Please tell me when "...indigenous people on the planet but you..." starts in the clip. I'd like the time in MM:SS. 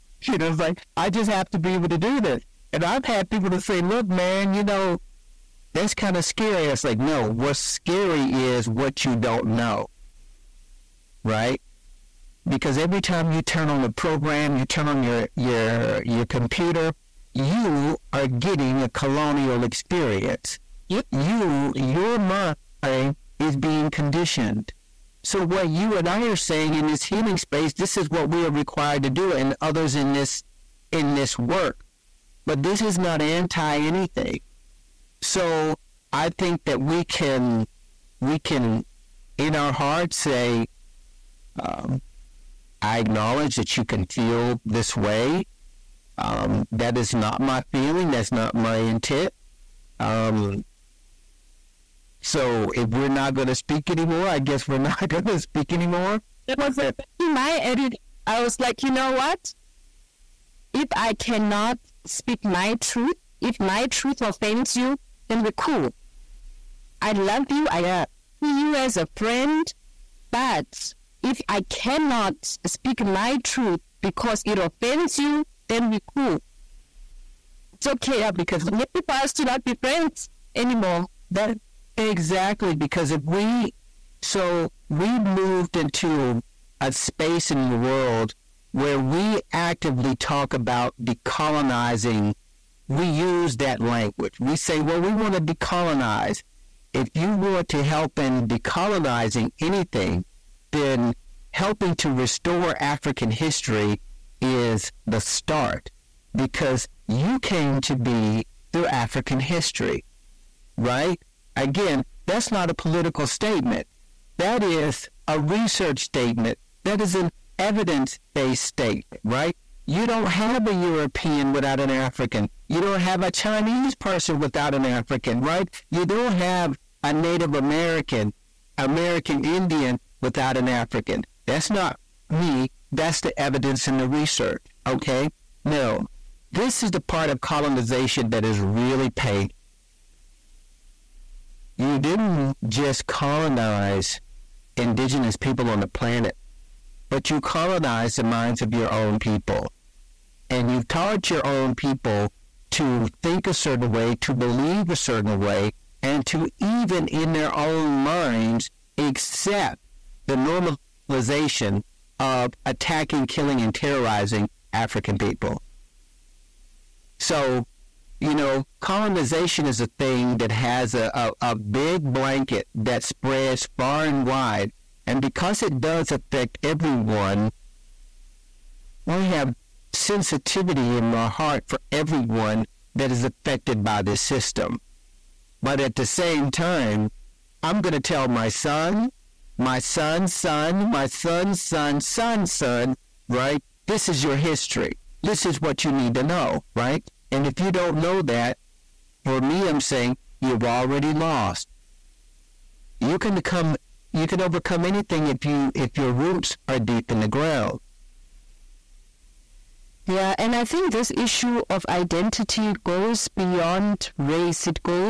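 02:24.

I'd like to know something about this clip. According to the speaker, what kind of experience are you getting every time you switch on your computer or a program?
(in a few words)
colonial experience.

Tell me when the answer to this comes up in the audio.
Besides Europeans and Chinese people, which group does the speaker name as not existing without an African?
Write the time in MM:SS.
02:07.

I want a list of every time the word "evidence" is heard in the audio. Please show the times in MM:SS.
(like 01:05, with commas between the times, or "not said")
01:57, 02:13.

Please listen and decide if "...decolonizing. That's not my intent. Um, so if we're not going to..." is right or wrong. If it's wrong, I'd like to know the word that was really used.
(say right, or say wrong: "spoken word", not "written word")
wrong: "feeling", not "decolonizing".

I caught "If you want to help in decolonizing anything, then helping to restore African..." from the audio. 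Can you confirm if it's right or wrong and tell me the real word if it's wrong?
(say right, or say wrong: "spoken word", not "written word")
right.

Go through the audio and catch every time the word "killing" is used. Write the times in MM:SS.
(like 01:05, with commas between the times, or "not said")
02:43.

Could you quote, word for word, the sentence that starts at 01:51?
Again, that's not a political statement.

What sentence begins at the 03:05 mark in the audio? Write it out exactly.
But at the same time, I'm going to tell my son, my son's son, my son's son, son's son, right?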